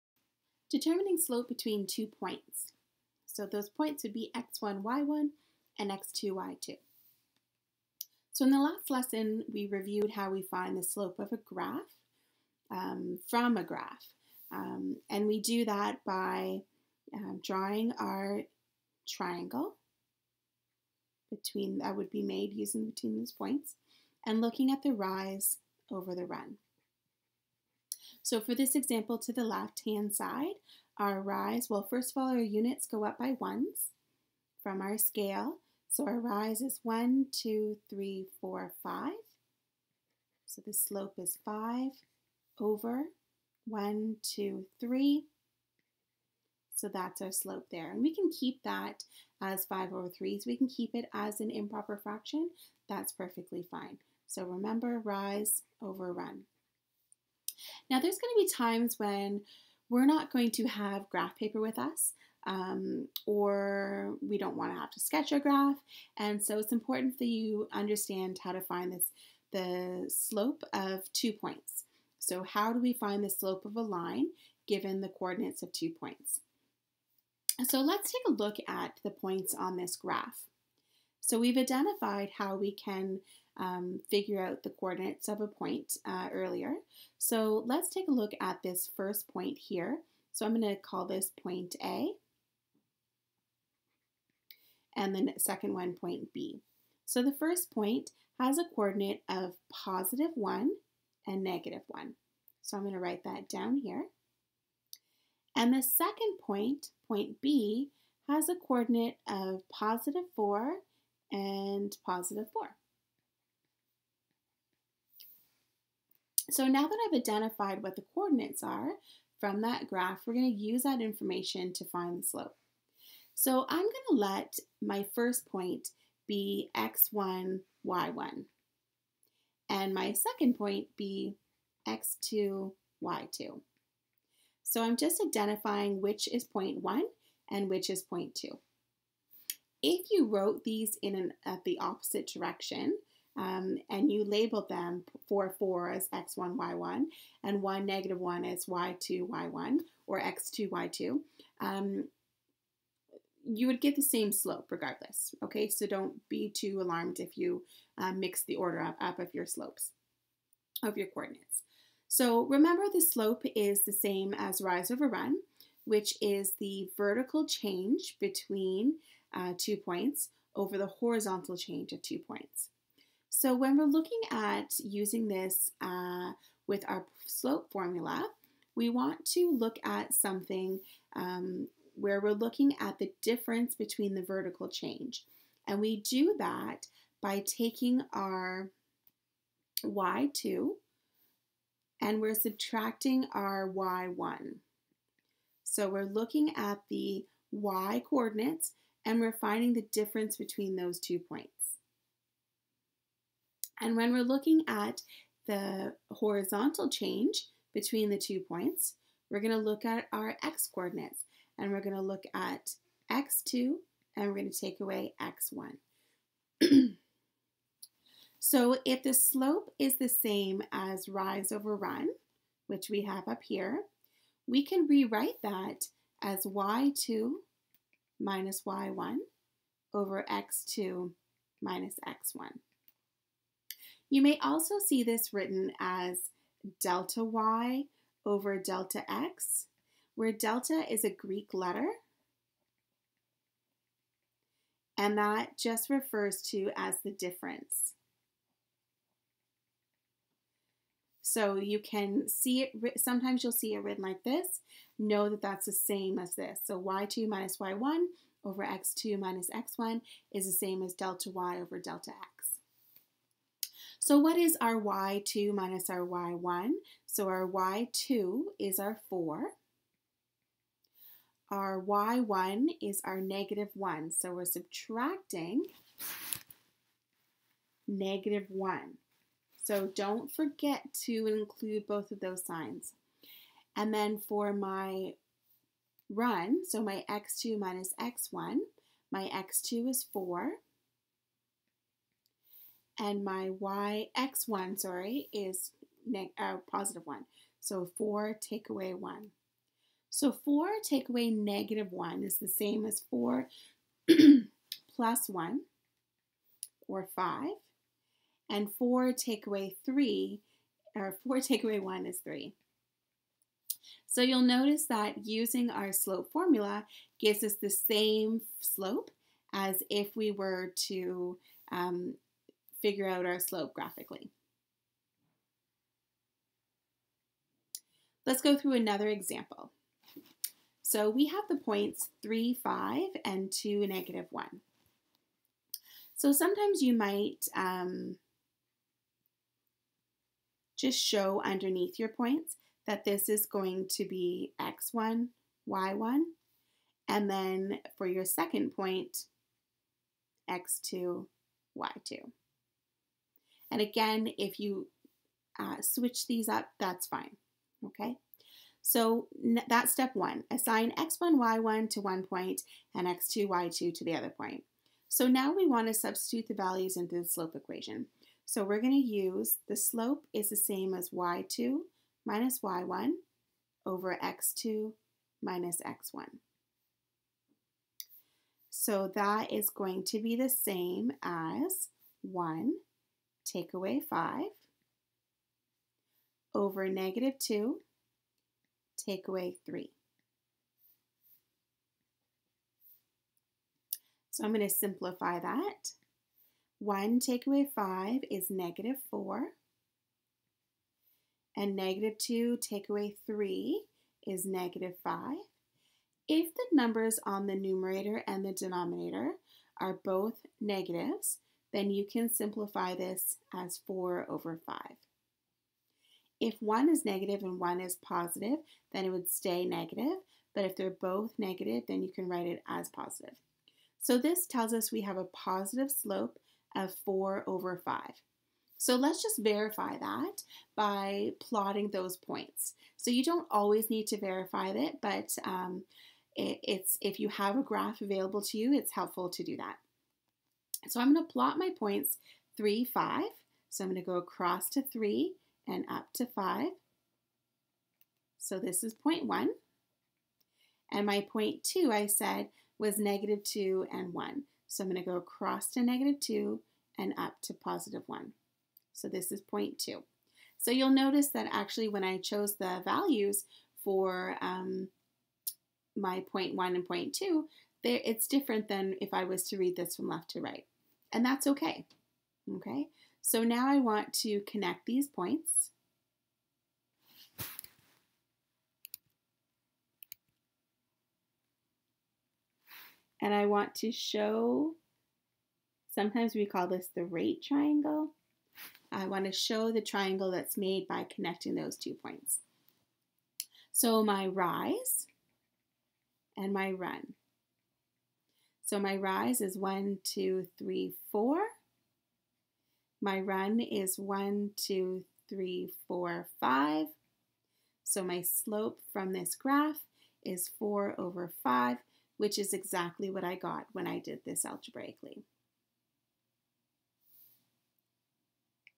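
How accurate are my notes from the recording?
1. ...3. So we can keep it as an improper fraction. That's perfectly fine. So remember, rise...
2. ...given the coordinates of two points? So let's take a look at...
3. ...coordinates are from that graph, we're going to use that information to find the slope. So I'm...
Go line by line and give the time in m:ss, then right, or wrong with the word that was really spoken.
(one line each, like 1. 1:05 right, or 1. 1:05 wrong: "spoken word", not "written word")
1. 0:50 right
2. 1:14 right
3. 1:58 right.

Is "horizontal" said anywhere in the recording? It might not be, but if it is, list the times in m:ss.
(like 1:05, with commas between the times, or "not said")
2:50, 3:26.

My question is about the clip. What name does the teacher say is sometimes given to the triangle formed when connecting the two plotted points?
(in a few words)
rate triangle.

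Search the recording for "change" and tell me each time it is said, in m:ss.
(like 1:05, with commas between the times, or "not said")
2:47, 2:51, 3:04, 3:26.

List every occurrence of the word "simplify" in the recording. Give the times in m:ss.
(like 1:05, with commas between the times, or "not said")
6:34, 6:52.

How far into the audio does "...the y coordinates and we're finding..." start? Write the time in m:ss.
3:16.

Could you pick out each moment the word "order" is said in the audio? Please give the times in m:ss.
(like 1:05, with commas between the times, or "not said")
2:38.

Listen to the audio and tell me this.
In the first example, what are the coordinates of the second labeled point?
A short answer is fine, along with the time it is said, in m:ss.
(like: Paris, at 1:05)
(4, 4), at 1:49.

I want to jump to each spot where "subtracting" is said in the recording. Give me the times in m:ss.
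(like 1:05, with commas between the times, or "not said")
3:12, 4:34.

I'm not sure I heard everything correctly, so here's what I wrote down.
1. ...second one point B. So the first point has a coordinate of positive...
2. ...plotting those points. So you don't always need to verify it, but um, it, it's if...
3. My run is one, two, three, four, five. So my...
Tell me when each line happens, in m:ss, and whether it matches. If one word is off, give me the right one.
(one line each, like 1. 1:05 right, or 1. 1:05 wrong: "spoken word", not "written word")
1. 1:35 right
2. 7:11 right
3. 8:23 right.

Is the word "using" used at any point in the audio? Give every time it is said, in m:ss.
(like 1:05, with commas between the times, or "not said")
0:22, 2:54, 5:15.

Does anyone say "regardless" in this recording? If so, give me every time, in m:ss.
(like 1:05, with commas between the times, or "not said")
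2:34.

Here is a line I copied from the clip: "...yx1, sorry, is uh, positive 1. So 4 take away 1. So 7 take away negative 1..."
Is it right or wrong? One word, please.
wrong.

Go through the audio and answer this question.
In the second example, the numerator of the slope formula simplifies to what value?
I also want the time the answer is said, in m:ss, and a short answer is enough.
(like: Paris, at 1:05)
-4, at 6:38.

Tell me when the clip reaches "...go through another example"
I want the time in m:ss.
5:28.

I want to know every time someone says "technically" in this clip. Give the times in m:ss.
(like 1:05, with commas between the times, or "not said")
not said.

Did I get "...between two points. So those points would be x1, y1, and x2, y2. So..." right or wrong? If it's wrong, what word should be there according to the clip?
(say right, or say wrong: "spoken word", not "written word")
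right.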